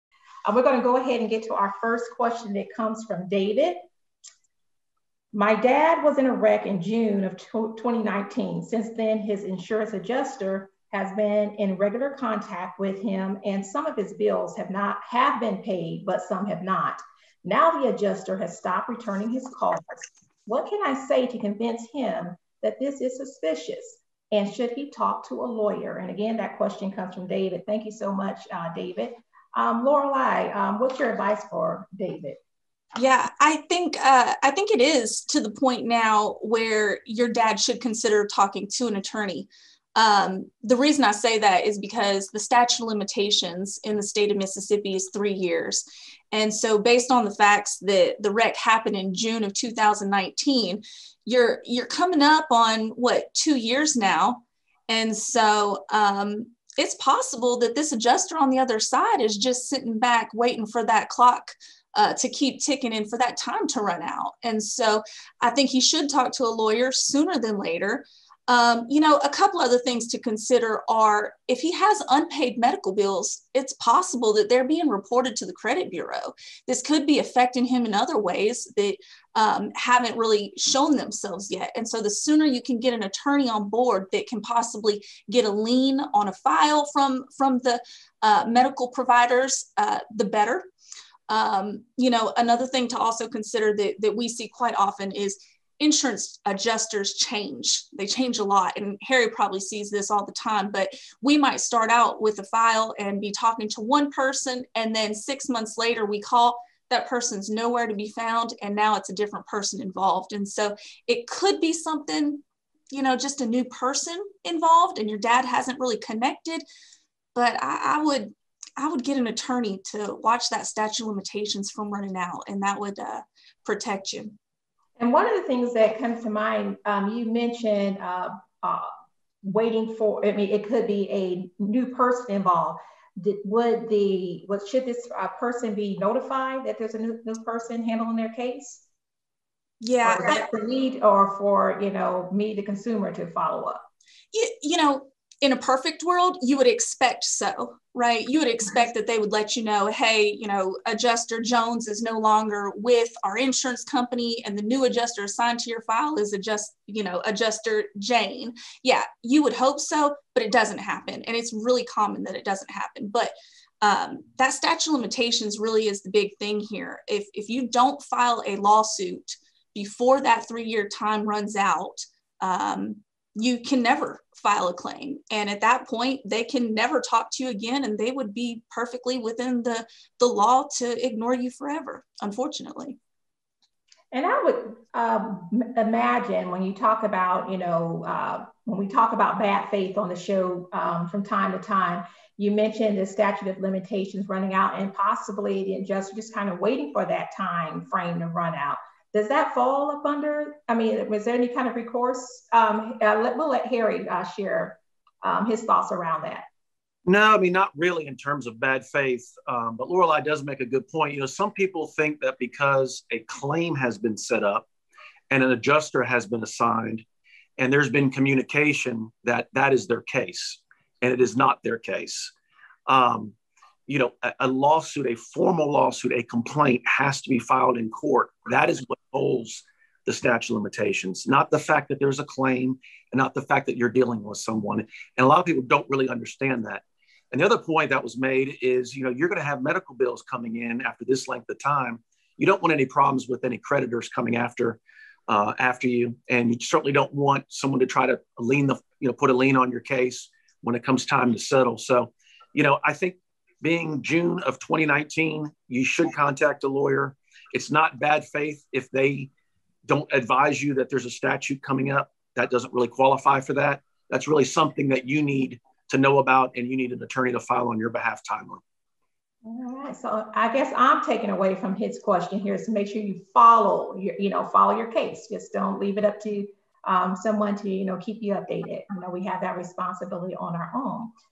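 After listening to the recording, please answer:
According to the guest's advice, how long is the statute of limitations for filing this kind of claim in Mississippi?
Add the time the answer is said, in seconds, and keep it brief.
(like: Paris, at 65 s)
3 years, at 45 s.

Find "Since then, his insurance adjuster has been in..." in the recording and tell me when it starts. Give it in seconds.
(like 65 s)
8 s.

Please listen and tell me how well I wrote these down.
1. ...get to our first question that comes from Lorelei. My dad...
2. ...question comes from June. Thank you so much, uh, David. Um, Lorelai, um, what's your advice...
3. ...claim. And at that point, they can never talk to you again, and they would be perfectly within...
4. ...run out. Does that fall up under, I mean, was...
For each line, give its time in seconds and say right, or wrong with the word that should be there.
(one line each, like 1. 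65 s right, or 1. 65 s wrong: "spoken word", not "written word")
1. 1 s wrong: "David", not "Lorelei"
2. 26 s wrong: "David", not "June"
3. 174 s right
4. 198 s right.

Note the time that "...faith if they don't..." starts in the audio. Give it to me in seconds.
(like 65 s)
258 s.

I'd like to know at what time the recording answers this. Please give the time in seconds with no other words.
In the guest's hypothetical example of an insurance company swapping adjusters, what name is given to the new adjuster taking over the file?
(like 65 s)
157 s.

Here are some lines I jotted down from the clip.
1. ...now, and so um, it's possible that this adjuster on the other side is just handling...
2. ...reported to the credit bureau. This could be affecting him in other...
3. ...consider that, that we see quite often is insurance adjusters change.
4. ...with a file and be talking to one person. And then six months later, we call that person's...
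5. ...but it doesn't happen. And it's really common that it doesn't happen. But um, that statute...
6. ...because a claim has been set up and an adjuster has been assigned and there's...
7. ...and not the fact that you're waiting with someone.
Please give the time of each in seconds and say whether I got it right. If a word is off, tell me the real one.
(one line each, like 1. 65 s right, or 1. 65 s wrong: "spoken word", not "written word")
1. 53 s wrong: "sitting", not "handling"
2. 74 s right
3. 93 s right
4. 102 s right
5. 160 s right
6. 212 s right
7. 233 s wrong: "dealing", not "waiting".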